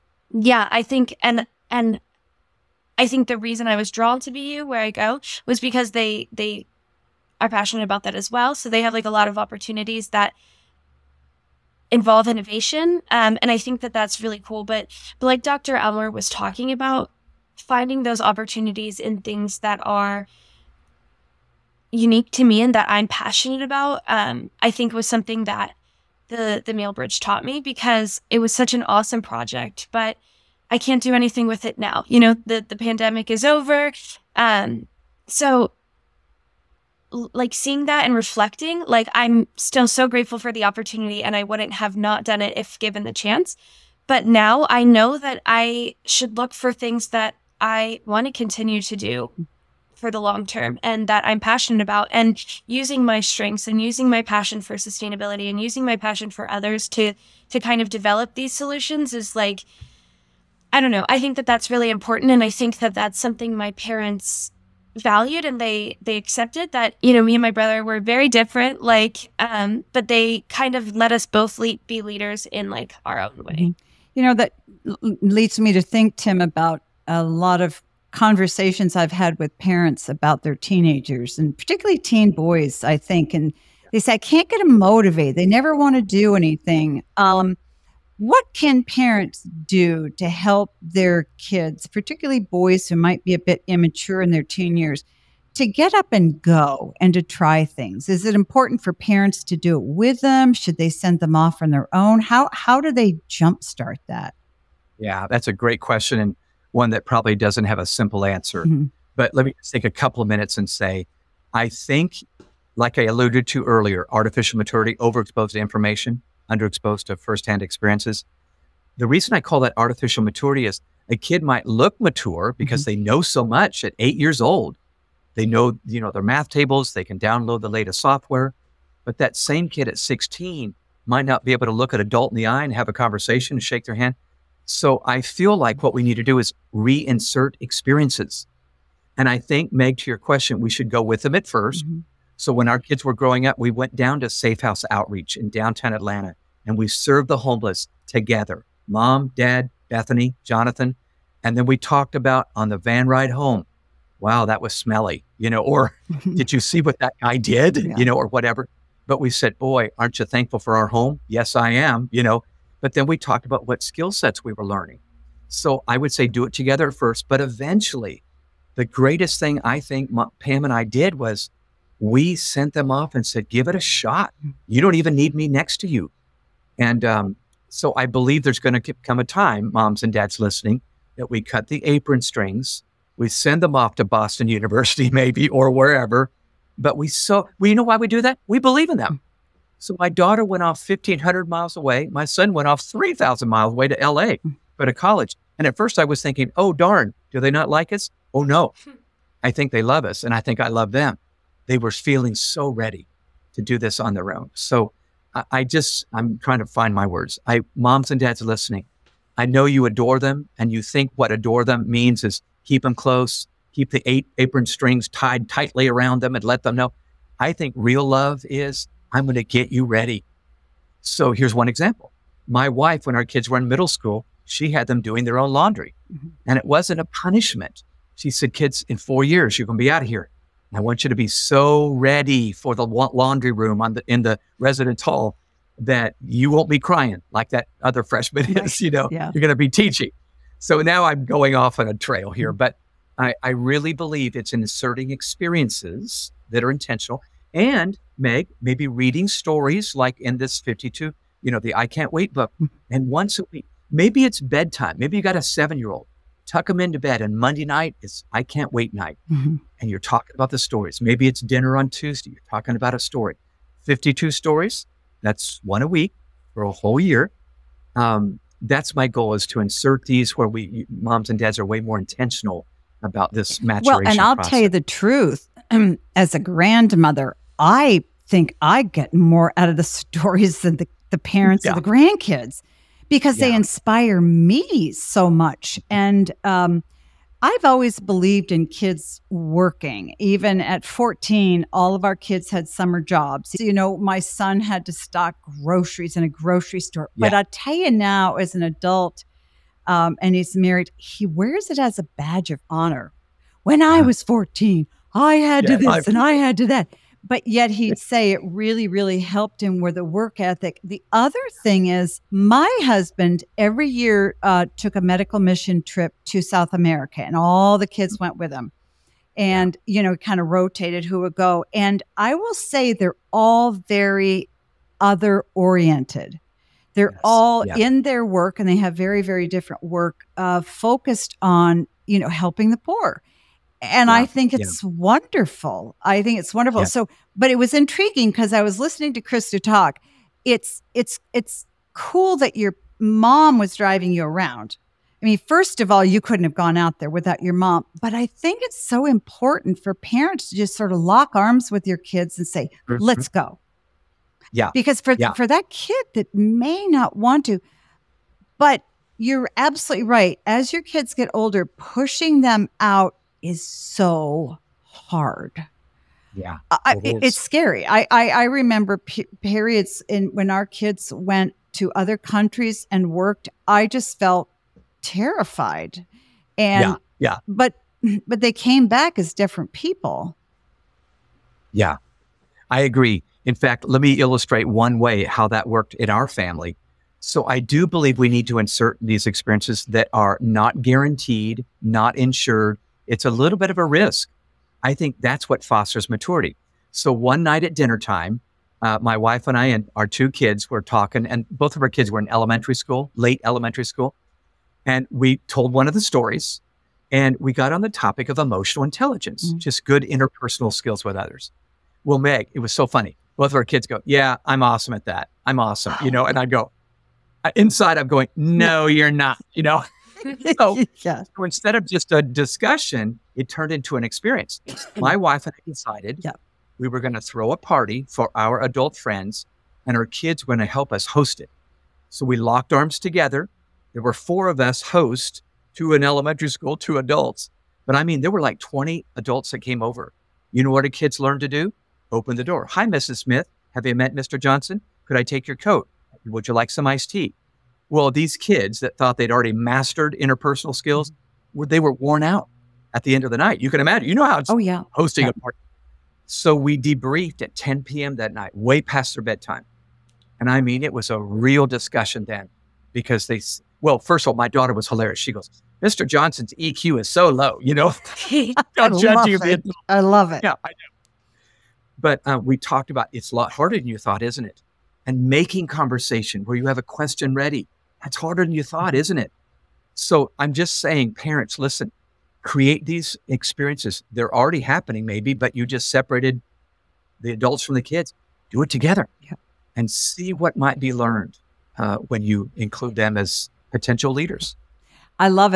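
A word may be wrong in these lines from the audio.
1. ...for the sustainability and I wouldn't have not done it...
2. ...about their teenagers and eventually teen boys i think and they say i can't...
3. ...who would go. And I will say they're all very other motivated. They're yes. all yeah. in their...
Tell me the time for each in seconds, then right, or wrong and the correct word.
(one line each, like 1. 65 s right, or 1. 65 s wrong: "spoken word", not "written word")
1. 40 s wrong: "opportunity", not "sustainability"
2. 80 s wrong: "particularly", not "eventually"
3. 321 s wrong: "oriented", not "motivated".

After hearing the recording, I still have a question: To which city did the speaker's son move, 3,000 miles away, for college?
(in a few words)
LA.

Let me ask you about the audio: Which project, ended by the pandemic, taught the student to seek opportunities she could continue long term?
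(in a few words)
Meal Bridge.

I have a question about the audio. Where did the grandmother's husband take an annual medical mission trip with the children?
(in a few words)
South America.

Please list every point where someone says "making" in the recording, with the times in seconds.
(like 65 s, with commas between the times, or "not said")
475 s.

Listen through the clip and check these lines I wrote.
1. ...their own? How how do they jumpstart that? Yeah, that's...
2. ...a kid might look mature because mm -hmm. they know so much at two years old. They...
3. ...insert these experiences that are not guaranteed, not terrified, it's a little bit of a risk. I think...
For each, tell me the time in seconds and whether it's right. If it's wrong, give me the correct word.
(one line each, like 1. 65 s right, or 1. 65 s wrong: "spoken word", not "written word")
1. 101 s right
2. 121 s wrong: "eight", not "two"
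3. 388 s wrong: "insured", not "terrified".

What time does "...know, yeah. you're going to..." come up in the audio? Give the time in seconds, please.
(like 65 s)
238 s.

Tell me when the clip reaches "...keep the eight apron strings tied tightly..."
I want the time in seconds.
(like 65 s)
213 s.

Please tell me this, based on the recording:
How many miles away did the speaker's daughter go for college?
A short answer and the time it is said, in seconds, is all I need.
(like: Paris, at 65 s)
1,500, at 190 s.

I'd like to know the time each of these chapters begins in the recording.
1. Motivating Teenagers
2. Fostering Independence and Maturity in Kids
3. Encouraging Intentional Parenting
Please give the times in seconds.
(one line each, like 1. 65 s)
1. 108 s
2. 201 s
3. 271 s.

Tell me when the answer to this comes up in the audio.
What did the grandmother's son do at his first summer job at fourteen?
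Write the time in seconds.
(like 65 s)
294 s.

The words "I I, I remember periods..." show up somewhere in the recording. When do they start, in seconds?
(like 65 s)
367 s.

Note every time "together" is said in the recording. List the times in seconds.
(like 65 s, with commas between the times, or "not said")
148 s, 166 s, 432 s, 488 s.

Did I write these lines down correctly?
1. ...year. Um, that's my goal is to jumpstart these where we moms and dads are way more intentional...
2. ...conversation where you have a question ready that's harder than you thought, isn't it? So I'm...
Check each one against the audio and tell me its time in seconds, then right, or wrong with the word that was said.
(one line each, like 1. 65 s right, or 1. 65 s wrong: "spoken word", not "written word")
1. 267 s wrong: "insert", not "jumpstart"
2. 475 s right.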